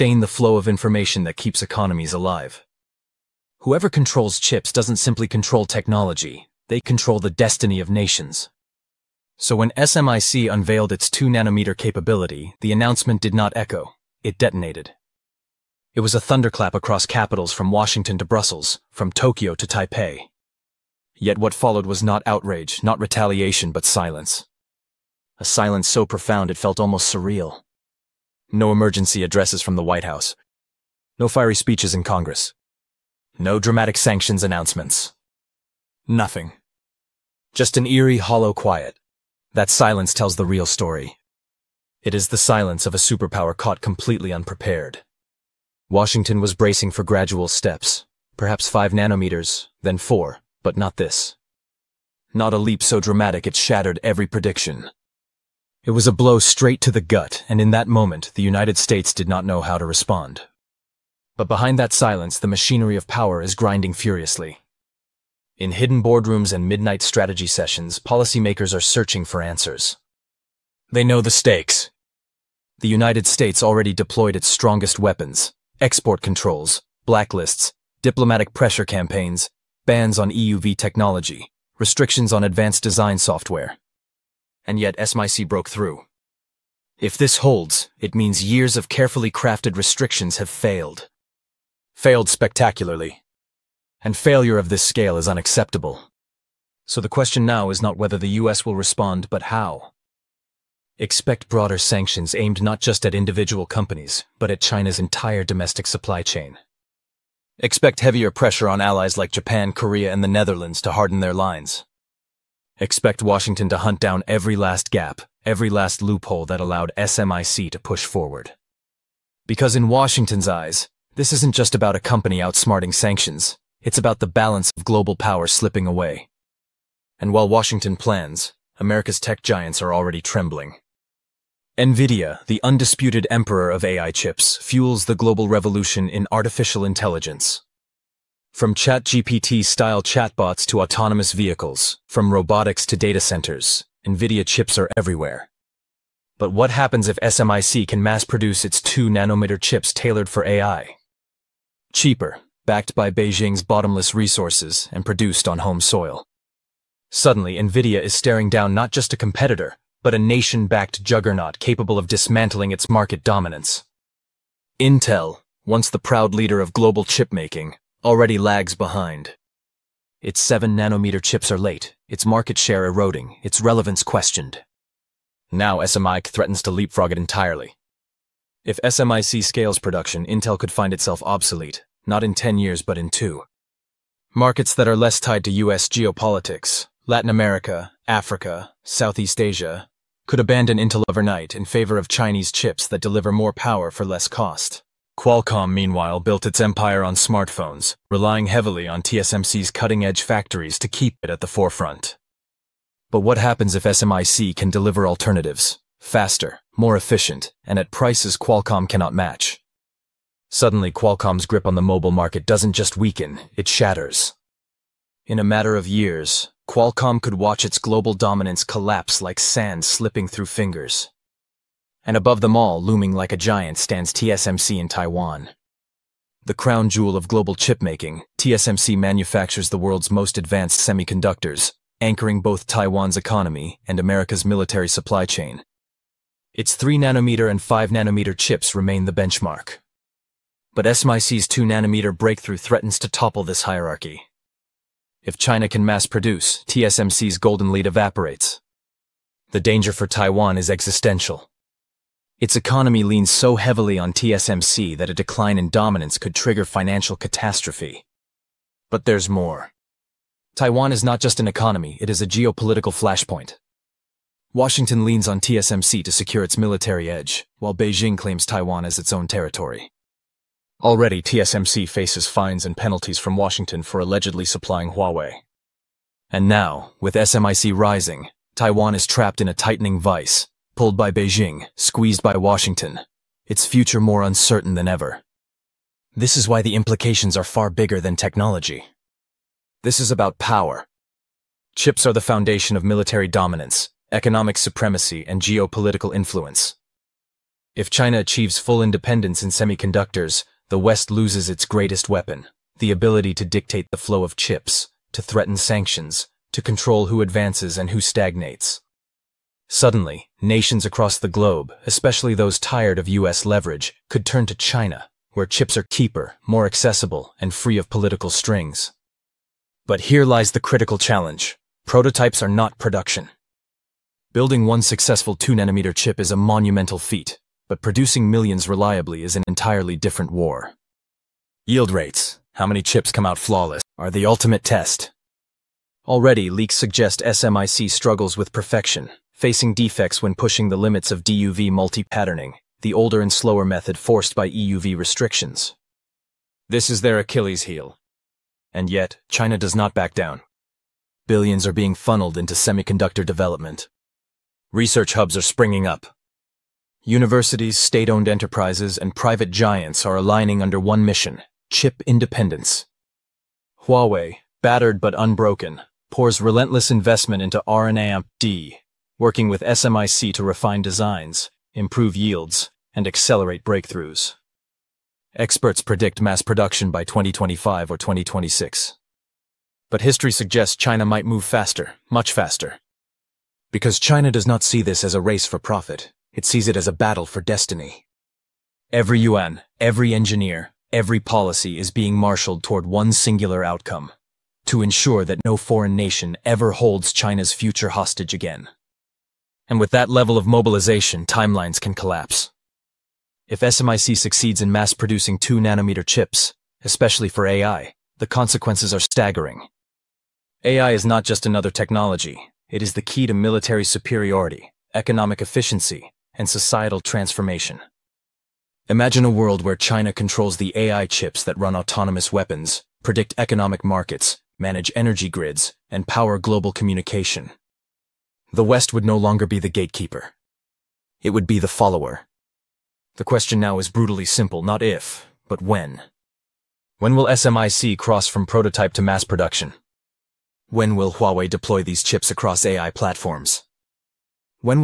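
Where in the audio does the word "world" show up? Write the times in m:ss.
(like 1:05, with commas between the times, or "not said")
3:49, 6:59.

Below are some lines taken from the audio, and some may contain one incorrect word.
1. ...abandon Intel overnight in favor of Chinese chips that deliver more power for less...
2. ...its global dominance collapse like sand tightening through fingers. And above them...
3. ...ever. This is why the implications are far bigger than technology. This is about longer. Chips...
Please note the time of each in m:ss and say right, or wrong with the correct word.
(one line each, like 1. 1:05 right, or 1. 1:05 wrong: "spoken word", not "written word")
1. 3:10 right
2. 3:37 wrong: "slipping", not "tightening"
3. 4:44 wrong: "power", not "longer".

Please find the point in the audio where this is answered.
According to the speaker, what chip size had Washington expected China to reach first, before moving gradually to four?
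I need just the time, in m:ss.
0:48.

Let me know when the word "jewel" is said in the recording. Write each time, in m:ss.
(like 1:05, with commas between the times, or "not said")
3:46.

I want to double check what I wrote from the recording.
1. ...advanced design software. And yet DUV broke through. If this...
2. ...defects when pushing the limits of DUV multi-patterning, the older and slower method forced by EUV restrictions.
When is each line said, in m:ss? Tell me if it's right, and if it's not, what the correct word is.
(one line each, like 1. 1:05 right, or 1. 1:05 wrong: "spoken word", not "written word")
1. 1:22 wrong: "SMIC", not "DUV"
2. 5:39 right.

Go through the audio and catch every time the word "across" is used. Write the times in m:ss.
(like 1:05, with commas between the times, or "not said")
0:16, 5:10, 7:22.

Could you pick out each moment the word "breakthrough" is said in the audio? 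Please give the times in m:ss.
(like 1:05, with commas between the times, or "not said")
4:02, 6:13.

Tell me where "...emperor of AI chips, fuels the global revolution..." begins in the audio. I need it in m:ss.
2:13.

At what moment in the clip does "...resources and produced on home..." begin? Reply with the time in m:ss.
2:34.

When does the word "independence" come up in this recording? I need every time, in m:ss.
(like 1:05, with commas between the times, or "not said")
4:58, 6:02.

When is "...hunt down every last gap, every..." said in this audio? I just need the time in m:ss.
1:53.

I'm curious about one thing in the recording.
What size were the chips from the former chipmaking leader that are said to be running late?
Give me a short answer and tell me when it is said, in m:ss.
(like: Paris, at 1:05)
7 nanometers, at 2:50.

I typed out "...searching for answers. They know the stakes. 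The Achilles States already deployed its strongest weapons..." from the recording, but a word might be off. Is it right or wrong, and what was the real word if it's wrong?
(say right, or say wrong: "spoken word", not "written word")
wrong: "United", not "Achilles".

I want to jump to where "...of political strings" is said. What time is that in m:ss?
5:17.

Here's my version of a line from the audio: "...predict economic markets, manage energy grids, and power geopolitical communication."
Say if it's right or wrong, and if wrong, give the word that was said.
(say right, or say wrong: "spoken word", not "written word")
wrong: "global", not "geopolitical".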